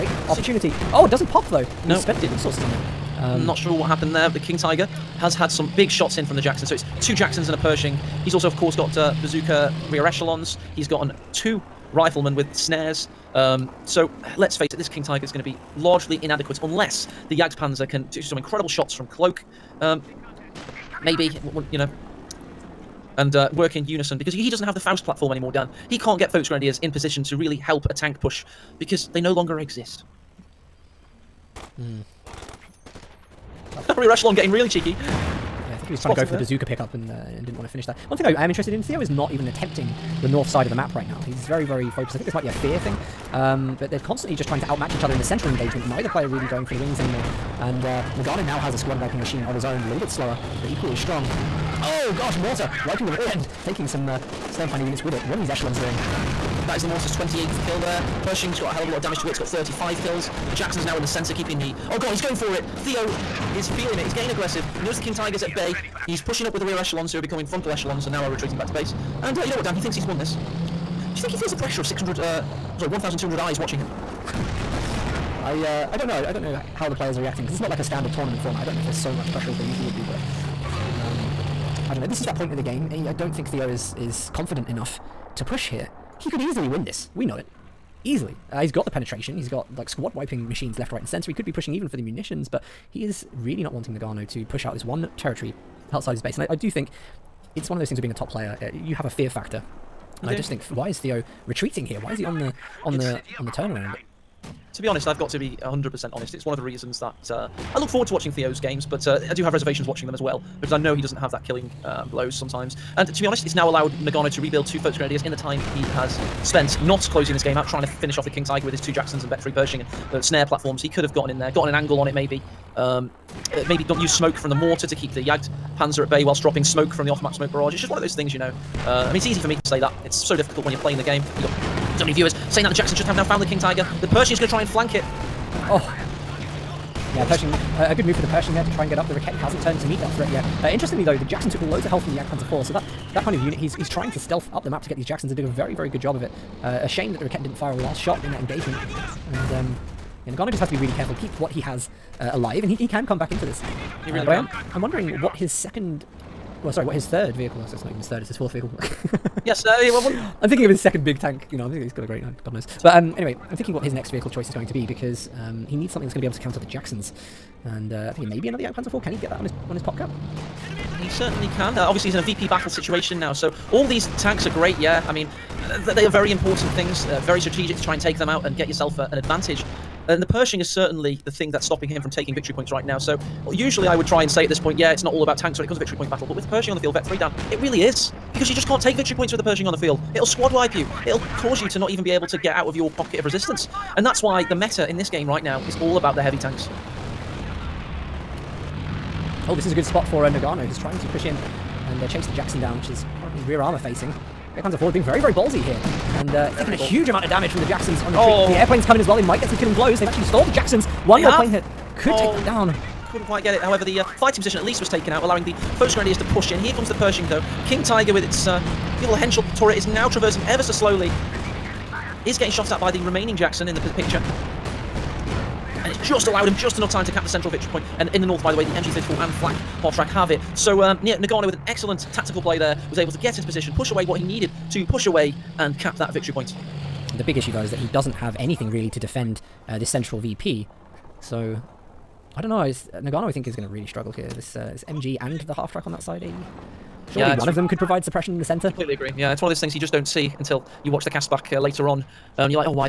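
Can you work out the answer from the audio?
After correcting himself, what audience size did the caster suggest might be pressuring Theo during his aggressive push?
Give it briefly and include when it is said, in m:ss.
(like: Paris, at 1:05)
1,200, at 1:12.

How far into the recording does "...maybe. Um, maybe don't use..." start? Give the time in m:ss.
2:02.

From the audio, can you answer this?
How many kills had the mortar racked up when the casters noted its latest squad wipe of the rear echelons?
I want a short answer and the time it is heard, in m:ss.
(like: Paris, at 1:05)
28, at 0:57.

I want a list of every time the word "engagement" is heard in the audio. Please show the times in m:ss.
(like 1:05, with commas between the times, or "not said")
0:45, 2:28.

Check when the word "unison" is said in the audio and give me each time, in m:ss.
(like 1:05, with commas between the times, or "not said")
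0:23.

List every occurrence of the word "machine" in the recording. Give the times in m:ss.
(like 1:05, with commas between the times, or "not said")
0:49, 1:30.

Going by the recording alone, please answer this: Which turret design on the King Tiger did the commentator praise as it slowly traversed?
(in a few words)
Henschel.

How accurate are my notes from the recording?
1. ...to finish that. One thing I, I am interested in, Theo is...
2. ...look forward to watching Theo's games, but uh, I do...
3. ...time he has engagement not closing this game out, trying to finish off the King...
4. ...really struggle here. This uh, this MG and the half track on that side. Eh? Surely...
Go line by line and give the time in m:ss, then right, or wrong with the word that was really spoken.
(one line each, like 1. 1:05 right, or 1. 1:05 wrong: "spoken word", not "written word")
1. 0:37 right
2. 1:47 right
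3. 1:55 wrong: "spent", not "engagement"
4. 4:03 right.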